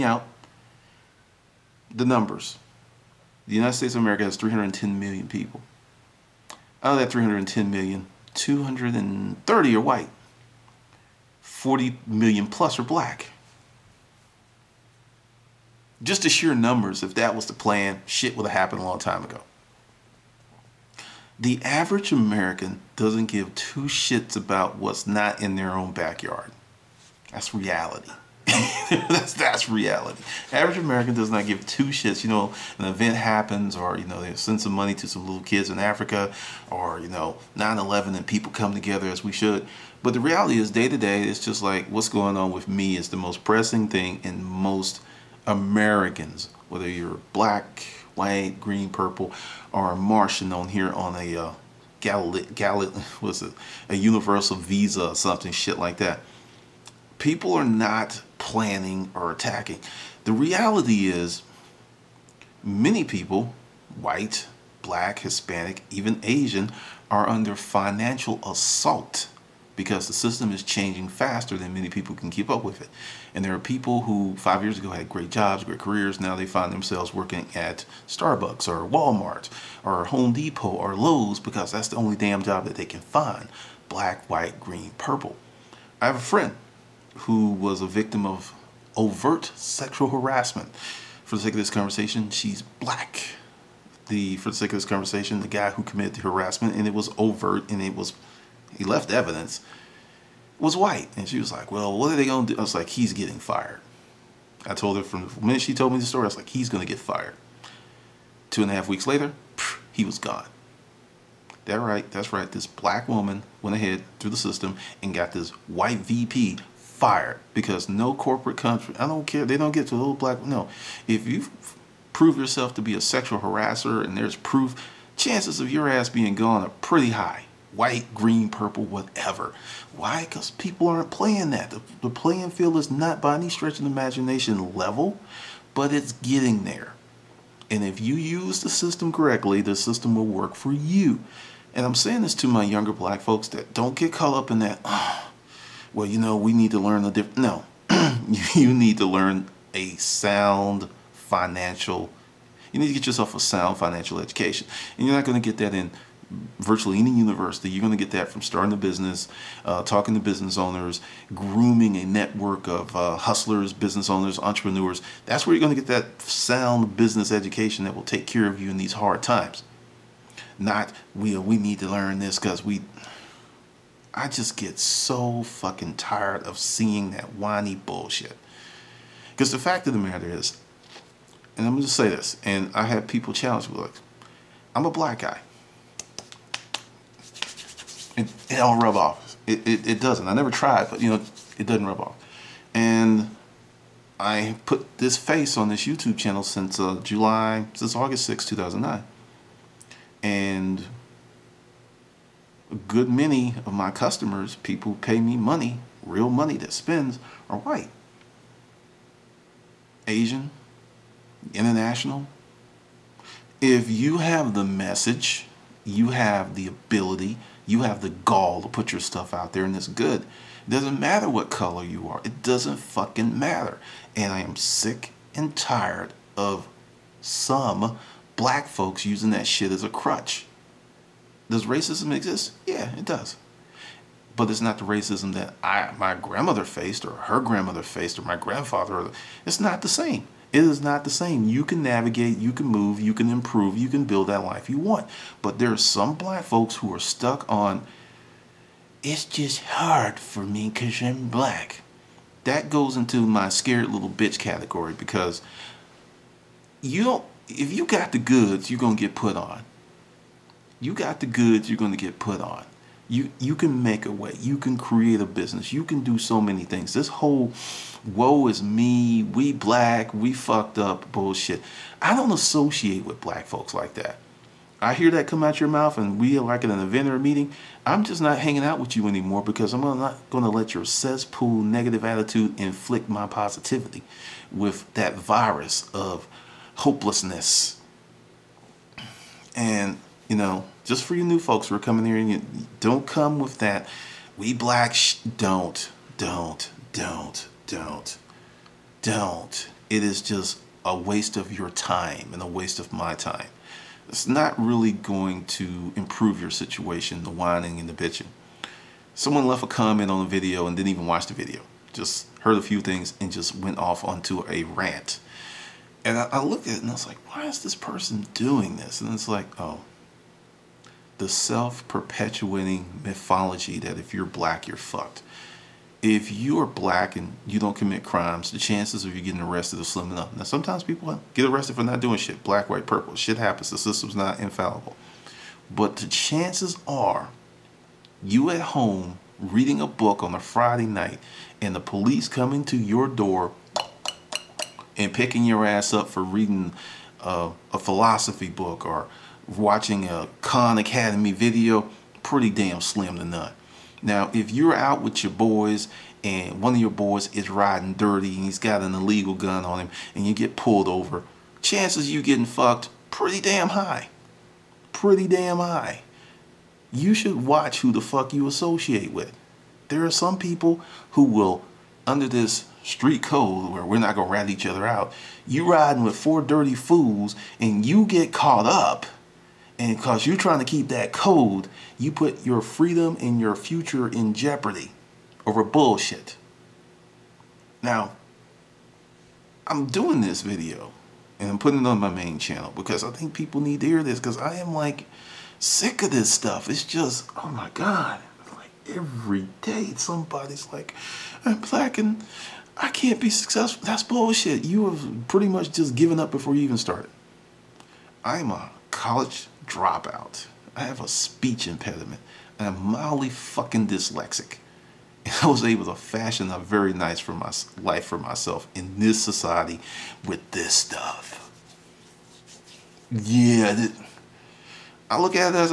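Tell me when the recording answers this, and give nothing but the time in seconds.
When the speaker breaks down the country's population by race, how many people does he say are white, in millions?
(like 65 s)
8 s.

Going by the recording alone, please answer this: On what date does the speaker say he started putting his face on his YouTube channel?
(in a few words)
August 6, 2009.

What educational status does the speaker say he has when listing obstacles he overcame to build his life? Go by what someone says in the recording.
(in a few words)
College dropout.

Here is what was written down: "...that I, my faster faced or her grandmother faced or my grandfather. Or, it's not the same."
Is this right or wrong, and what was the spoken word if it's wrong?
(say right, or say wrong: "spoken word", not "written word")
wrong: "grandmother", not "faster".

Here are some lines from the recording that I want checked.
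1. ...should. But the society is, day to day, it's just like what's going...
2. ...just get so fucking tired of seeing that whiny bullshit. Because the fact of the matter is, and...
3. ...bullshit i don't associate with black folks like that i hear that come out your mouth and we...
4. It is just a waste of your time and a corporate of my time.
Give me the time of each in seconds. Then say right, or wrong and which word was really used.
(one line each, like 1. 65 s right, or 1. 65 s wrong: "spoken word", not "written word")
1. 39 s wrong: "reality", not "society"
2. 174 s right
3. 271 s right
4. 299 s wrong: "waste", not "corporate".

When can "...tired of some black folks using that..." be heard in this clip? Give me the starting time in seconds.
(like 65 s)
225 s.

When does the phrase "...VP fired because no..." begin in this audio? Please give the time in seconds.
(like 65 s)
115 s.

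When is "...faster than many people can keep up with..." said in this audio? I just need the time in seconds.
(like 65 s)
71 s.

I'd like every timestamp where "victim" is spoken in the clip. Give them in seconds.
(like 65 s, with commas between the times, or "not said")
87 s.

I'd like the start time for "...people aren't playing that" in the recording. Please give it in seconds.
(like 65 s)
130 s.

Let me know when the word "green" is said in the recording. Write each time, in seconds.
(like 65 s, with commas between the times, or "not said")
48 s, 84 s, 128 s.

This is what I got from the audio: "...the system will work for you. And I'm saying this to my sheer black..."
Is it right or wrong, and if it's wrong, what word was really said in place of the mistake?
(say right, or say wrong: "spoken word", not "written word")
wrong: "younger", not "sheer".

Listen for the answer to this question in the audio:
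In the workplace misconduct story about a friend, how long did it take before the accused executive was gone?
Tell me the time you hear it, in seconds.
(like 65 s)
108 s.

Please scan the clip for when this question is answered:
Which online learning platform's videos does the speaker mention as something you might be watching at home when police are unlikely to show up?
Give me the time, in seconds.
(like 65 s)
350 s.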